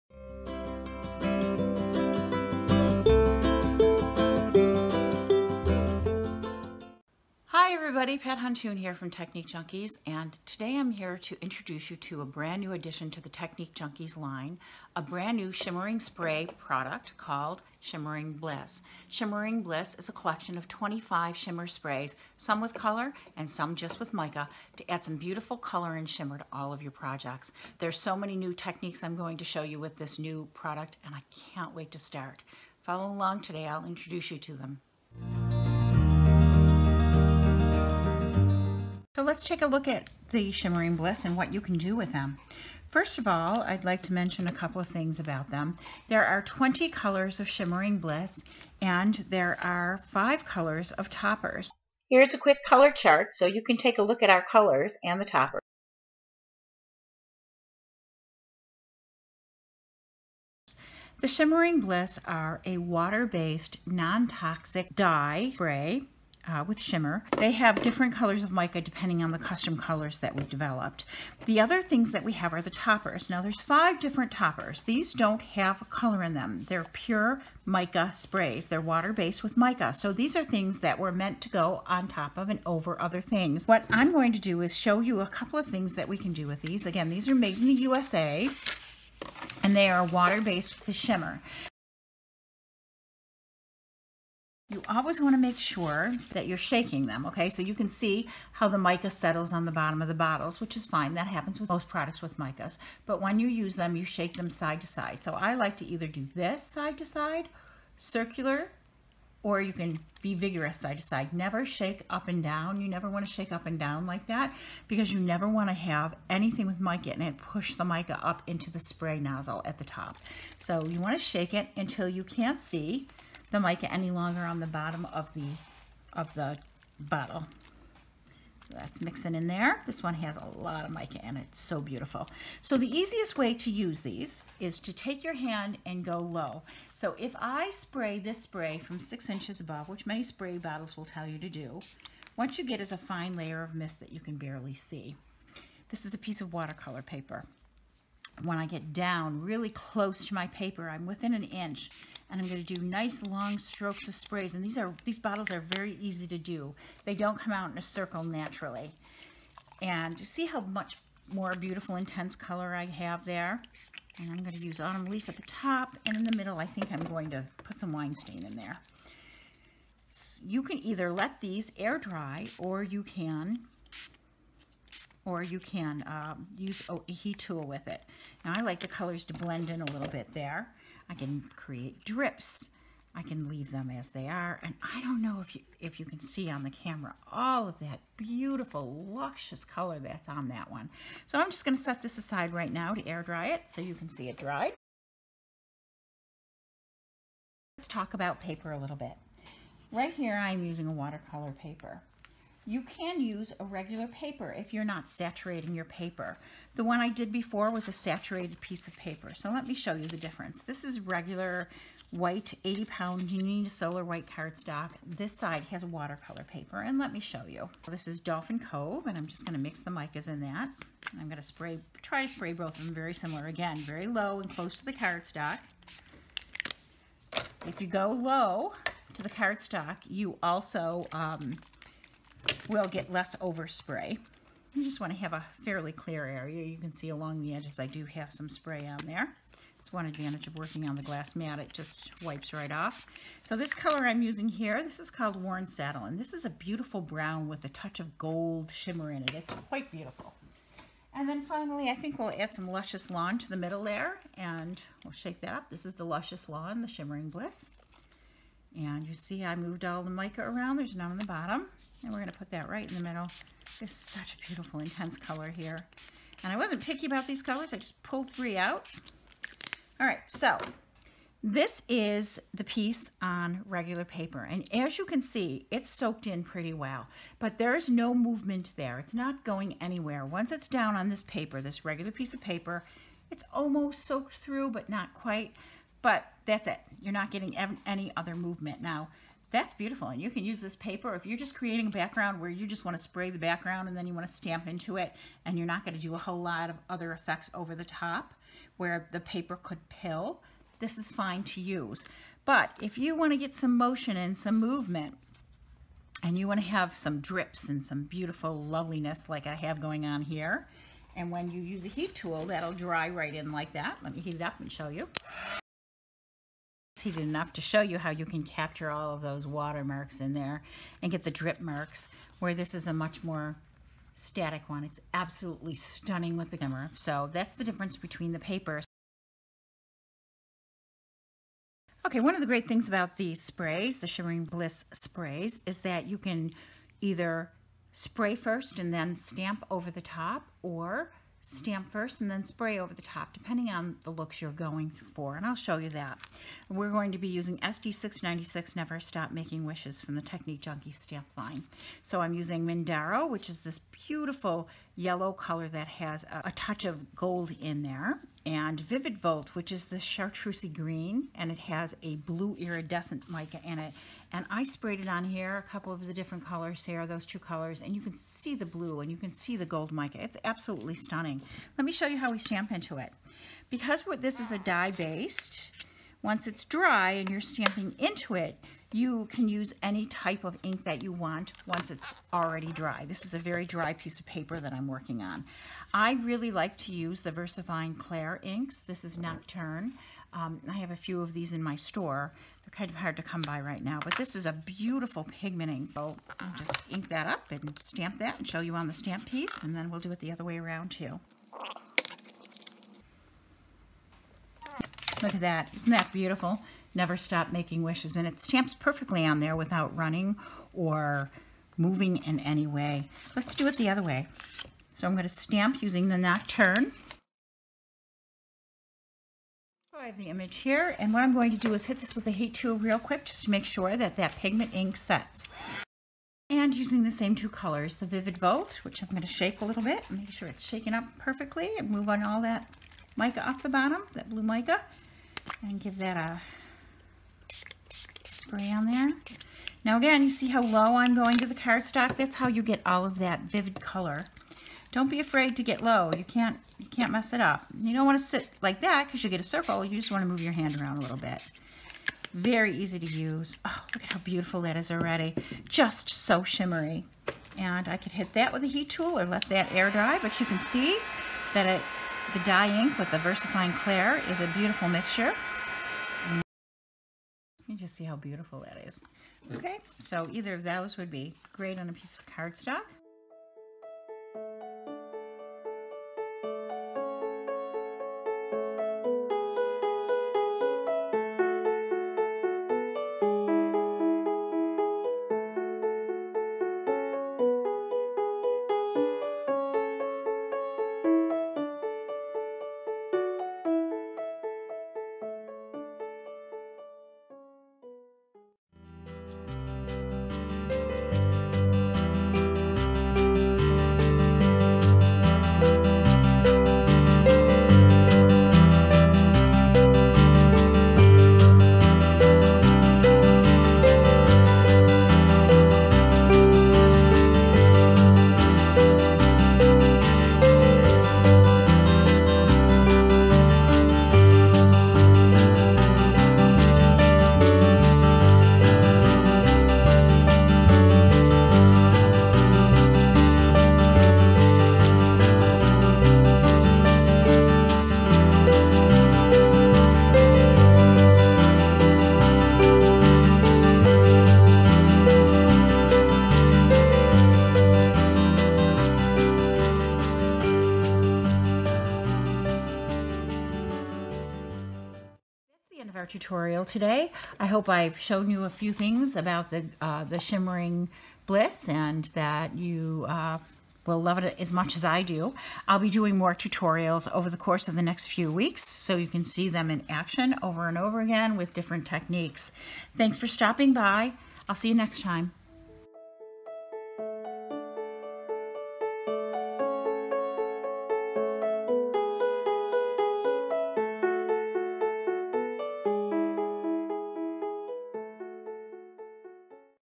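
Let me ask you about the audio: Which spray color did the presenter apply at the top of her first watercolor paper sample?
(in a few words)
Autumn Leaf.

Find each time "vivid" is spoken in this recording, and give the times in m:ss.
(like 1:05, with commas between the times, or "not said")
5:58, 7:08, 7:23.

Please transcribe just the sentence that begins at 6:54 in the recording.
So I'm going to stamp using the Nocturne.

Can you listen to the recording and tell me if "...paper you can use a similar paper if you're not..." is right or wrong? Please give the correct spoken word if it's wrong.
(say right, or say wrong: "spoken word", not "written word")
wrong: "regular", not "similar".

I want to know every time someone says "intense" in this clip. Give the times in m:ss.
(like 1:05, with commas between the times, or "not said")
2:41, 4:24.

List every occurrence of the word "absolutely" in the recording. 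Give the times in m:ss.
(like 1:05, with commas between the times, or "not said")
5:25, 6:10.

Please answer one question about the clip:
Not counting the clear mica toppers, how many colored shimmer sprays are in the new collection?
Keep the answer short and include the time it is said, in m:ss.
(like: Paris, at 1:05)
20, at 0:46.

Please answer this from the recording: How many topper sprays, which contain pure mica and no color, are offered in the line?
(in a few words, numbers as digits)
5.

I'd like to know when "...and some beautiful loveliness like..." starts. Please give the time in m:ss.
5:07.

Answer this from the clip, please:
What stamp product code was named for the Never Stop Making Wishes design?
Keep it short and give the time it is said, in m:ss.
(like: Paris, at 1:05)
SD696, at 5:47.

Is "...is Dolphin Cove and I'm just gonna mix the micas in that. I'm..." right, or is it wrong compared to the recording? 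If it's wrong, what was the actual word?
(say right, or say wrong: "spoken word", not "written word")
right.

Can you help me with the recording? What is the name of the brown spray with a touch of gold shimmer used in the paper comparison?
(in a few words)
Warren Saddle.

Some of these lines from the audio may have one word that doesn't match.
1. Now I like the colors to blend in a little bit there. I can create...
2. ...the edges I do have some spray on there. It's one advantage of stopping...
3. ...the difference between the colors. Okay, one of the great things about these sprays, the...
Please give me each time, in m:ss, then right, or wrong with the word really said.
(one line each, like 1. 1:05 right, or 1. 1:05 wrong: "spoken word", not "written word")
1. 2:58 right
2. 3:57 wrong: "working", not "stopping"
3. 5:27 wrong: "papers", not "colors".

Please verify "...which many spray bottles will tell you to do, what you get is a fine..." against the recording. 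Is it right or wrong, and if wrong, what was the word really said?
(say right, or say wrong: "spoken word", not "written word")
right.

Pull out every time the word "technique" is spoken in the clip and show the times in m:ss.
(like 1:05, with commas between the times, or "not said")
0:09, 0:13, 0:28, 5:50, 9:31.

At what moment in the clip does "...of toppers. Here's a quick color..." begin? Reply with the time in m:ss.
0:50.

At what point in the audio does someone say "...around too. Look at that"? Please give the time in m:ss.
6:40.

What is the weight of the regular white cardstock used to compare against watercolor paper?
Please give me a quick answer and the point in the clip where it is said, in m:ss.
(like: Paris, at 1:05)
80 pound, at 3:32.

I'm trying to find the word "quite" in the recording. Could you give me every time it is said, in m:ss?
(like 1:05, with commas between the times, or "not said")
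4:09, 4:45.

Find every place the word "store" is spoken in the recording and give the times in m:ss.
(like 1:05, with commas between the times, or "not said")
6:31.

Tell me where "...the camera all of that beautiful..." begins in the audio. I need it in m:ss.
3:06.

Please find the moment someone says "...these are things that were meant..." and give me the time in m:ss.
1:20.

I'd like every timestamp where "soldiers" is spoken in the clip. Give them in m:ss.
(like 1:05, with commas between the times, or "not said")
not said.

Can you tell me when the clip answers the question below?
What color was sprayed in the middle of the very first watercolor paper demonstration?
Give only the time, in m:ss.
2:47.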